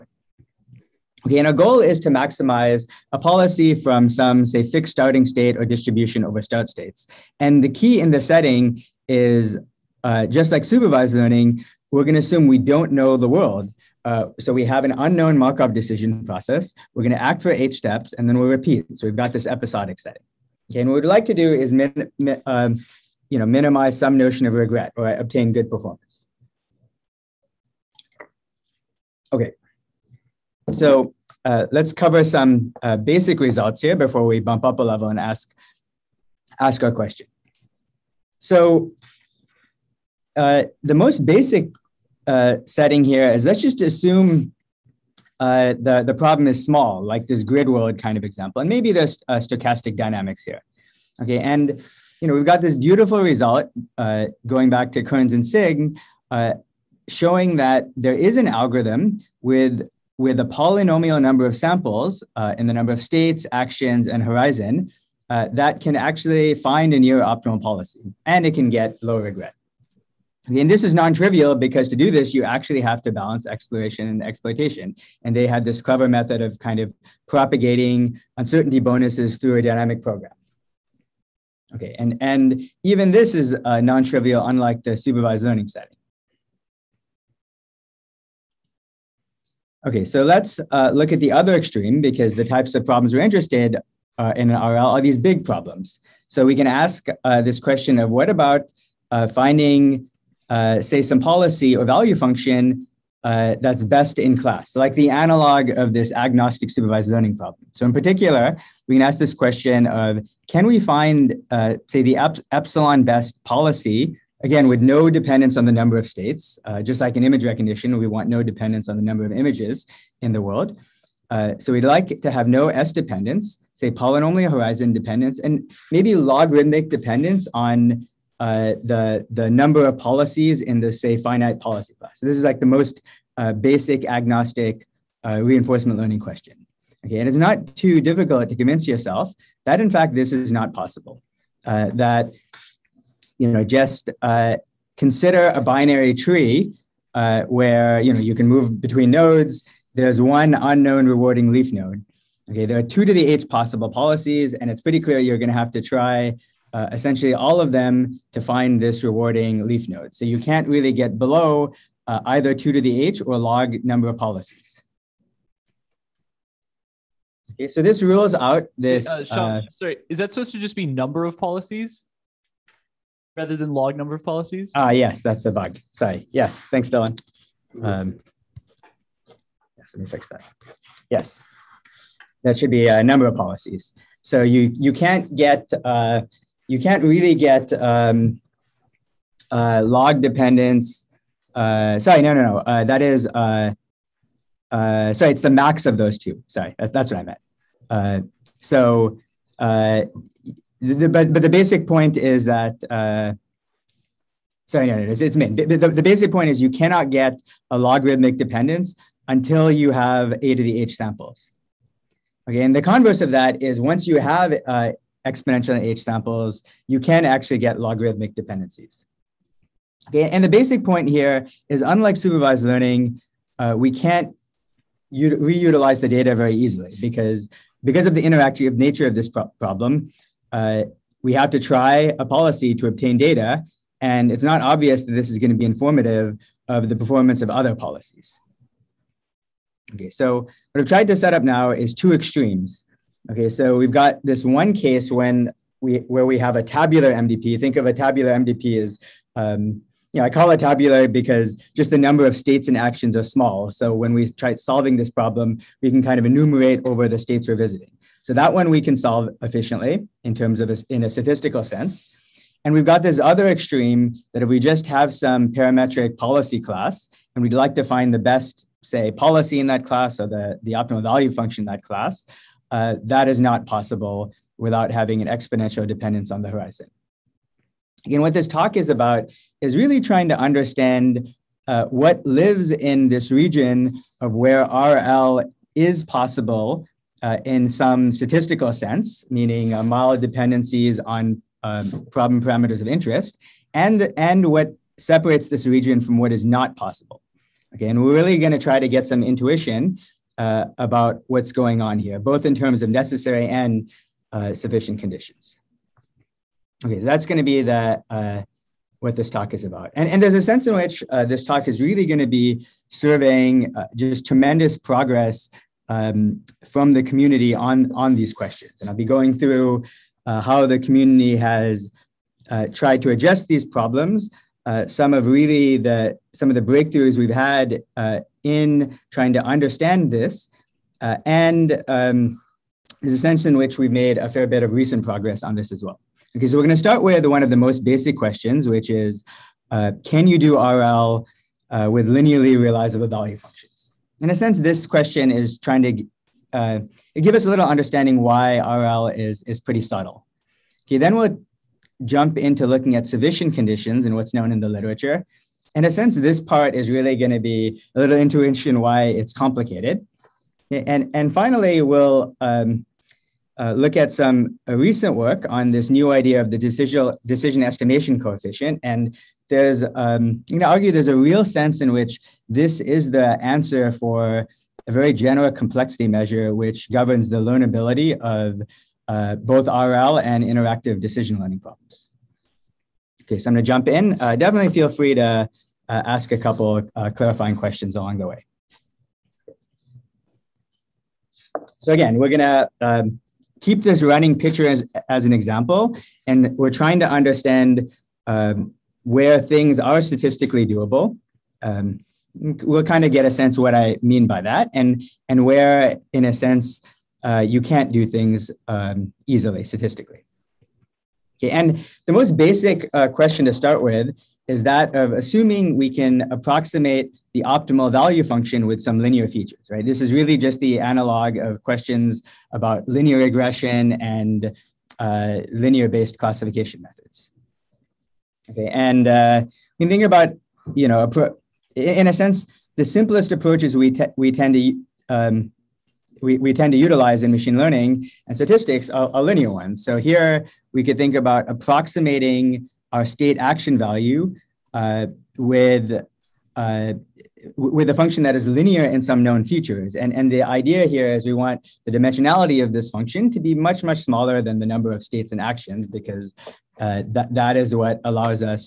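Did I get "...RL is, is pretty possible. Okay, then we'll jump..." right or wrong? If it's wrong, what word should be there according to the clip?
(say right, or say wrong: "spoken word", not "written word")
wrong: "subtle", not "possible".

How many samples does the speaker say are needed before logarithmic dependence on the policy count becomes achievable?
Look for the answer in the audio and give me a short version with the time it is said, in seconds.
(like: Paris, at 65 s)
A to the H, at 210 s.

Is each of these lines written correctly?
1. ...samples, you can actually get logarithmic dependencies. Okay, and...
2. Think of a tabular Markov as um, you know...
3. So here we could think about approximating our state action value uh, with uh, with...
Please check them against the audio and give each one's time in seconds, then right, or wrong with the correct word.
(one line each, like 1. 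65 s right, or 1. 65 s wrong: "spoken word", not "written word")
1. 216 s right
2. 247 s wrong: "MDP", not "Markov"
3. 439 s right.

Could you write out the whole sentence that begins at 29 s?
Okay, so uh, let's cover some uh, basic results here before we bump up a level and ask, ask our question.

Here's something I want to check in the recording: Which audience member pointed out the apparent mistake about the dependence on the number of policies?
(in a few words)
Dylan.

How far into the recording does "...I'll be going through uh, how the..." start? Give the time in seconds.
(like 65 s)
318 s.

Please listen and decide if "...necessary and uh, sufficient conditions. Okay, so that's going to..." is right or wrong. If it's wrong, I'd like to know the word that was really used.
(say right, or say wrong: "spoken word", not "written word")
right.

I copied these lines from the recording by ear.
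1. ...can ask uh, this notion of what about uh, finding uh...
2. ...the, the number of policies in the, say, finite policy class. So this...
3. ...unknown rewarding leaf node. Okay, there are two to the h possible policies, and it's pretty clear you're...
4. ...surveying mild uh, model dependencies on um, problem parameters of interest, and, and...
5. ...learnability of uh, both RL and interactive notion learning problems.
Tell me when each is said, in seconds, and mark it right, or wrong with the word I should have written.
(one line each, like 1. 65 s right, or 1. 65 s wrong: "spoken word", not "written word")
1. 96 s wrong: "question", not "notion"
2. 128 s right
3. 150 s right
4. 289 s wrong: "meaning", not "surveying"
5. 377 s wrong: "decision", not "notion".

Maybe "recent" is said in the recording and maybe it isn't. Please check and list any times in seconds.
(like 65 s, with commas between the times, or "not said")
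334 s, 364 s.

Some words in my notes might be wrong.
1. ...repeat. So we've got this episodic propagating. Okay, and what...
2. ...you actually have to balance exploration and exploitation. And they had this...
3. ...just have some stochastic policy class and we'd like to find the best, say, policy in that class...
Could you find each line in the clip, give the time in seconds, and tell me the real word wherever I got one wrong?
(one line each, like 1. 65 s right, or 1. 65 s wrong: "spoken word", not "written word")
1. 18 s wrong: "setting", not "propagating"
2. 72 s right
3. 264 s wrong: "parametric", not "stochastic".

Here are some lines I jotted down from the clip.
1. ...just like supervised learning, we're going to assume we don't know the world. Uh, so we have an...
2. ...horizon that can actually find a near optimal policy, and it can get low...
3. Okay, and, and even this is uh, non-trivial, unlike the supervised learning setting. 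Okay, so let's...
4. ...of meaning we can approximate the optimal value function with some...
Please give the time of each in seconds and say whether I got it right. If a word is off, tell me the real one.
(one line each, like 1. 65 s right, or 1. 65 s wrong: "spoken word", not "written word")
1. 10 s right
2. 64 s right
3. 81 s right
4. 414 s wrong: "assuming", not "meaning".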